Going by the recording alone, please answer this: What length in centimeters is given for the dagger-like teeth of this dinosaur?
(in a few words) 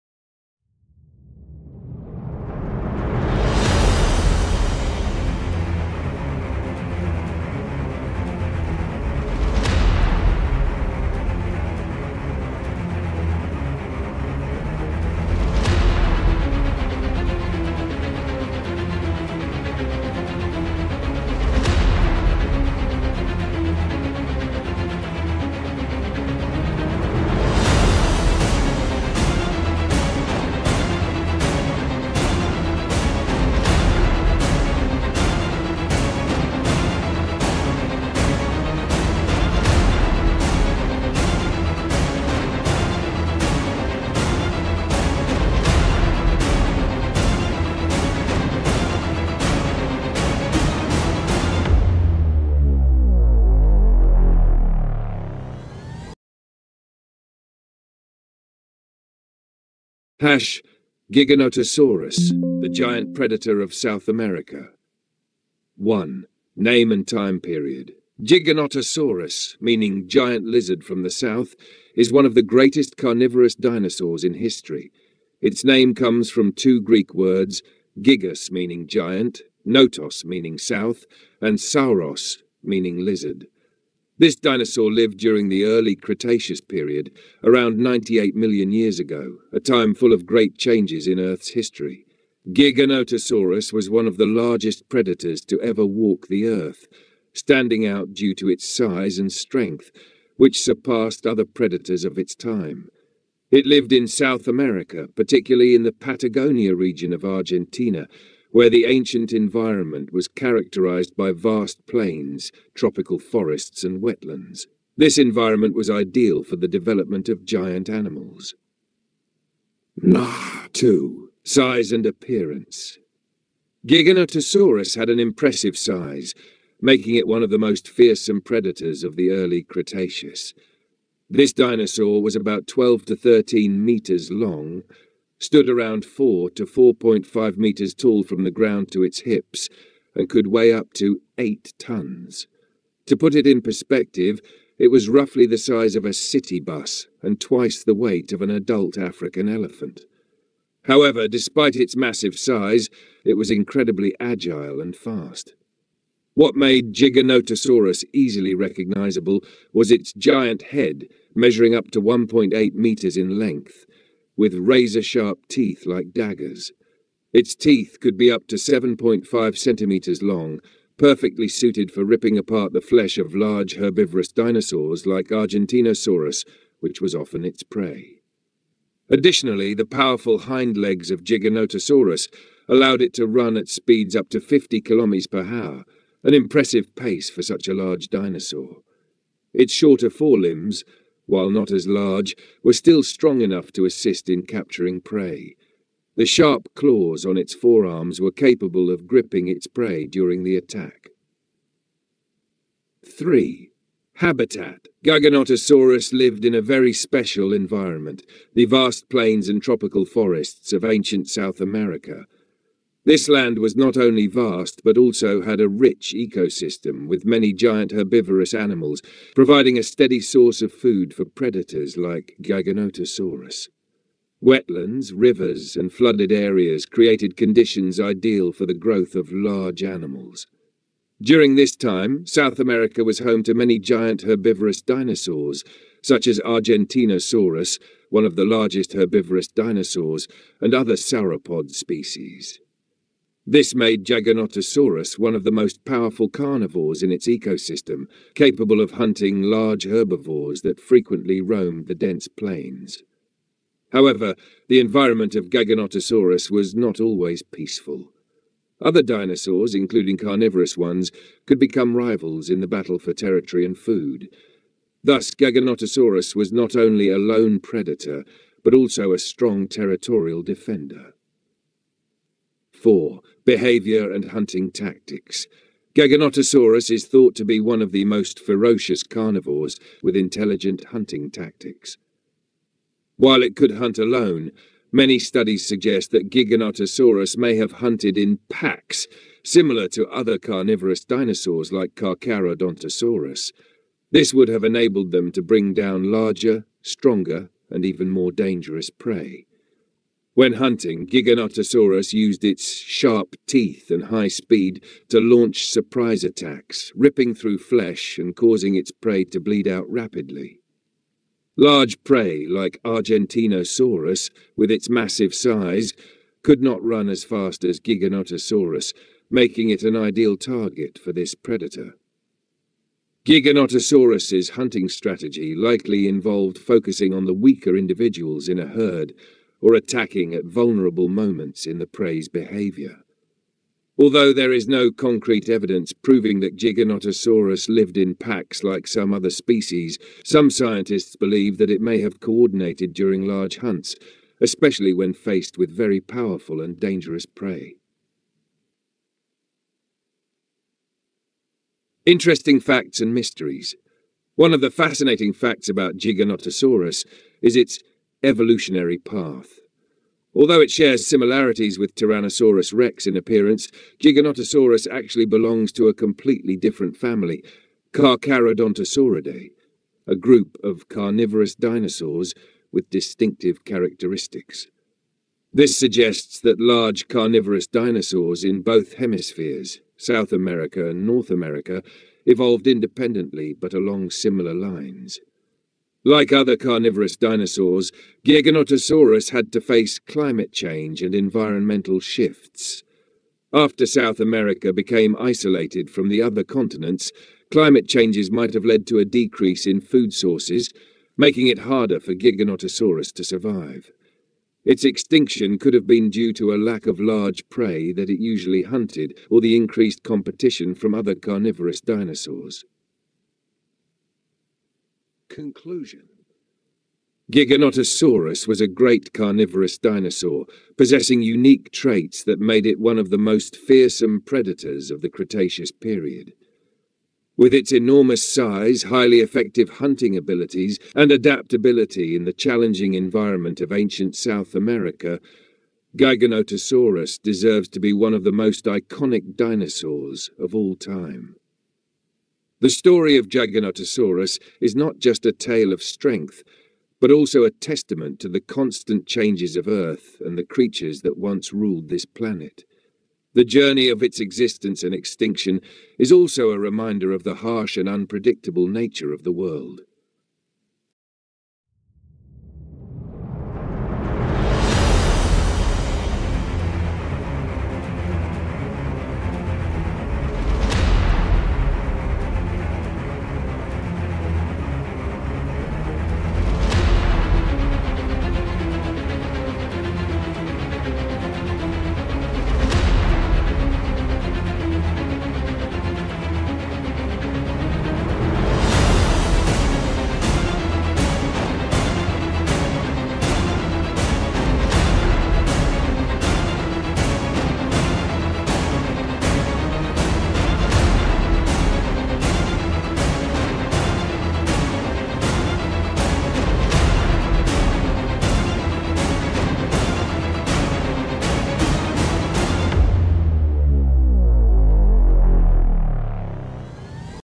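7.5 centimeters.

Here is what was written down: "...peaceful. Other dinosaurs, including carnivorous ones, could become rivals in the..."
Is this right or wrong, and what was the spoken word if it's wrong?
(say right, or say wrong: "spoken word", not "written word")
right.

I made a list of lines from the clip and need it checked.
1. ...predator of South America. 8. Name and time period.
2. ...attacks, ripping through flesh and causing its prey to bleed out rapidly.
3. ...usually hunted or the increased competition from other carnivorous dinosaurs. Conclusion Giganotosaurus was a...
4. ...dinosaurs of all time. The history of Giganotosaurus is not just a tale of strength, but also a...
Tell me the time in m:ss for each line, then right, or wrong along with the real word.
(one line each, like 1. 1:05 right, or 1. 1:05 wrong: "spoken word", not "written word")
1. 1:03 wrong: "1", not "8"
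2. 5:06 right
3. 6:48 right
4. 7:19 wrong: "story", not "history".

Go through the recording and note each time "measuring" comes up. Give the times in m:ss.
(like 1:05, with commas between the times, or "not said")
2:41.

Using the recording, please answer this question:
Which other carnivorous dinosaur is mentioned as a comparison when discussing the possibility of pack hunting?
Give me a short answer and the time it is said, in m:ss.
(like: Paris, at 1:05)
Carcharodontosaurus, at 4:51.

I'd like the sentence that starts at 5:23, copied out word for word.
Giganotosaurus's hunting strategy likely involved focusing on the weaker individuals in a herd, or attacking at vulnerable moments in the prey's behavior.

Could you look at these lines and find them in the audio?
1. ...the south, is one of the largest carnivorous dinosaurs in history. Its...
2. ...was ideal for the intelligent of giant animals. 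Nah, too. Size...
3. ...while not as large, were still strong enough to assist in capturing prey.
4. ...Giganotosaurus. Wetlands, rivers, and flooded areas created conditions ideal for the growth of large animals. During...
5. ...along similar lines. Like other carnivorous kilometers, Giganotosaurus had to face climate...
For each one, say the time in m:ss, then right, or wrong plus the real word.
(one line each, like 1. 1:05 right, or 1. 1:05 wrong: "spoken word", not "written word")
1. 1:11 wrong: "greatest", not "largest"
2. 1:55 wrong: "development", not "intelligent"
3. 3:11 right
4. 3:42 right
5. 6:23 wrong: "dinosaurs", not "kilometers".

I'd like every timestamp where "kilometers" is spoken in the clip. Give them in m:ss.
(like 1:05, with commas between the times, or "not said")
3:04.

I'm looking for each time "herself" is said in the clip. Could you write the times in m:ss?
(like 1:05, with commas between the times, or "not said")
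not said.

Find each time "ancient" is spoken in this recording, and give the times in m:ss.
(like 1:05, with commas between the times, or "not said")
1:48, 3:30, 7:13.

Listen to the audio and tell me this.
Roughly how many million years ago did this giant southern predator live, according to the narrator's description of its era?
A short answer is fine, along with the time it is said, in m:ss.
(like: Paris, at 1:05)
98 million years, at 1:27.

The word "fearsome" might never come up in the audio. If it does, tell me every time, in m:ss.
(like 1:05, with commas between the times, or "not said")
2:07, 7:03.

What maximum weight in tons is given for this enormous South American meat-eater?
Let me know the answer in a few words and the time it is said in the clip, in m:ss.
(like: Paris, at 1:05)
8 tons, at 2:21.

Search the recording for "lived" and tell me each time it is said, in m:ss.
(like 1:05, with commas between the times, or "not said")
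1:24, 1:43, 3:26, 5:37.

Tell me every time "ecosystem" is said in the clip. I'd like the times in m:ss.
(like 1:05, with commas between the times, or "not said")
3:36, 4:07.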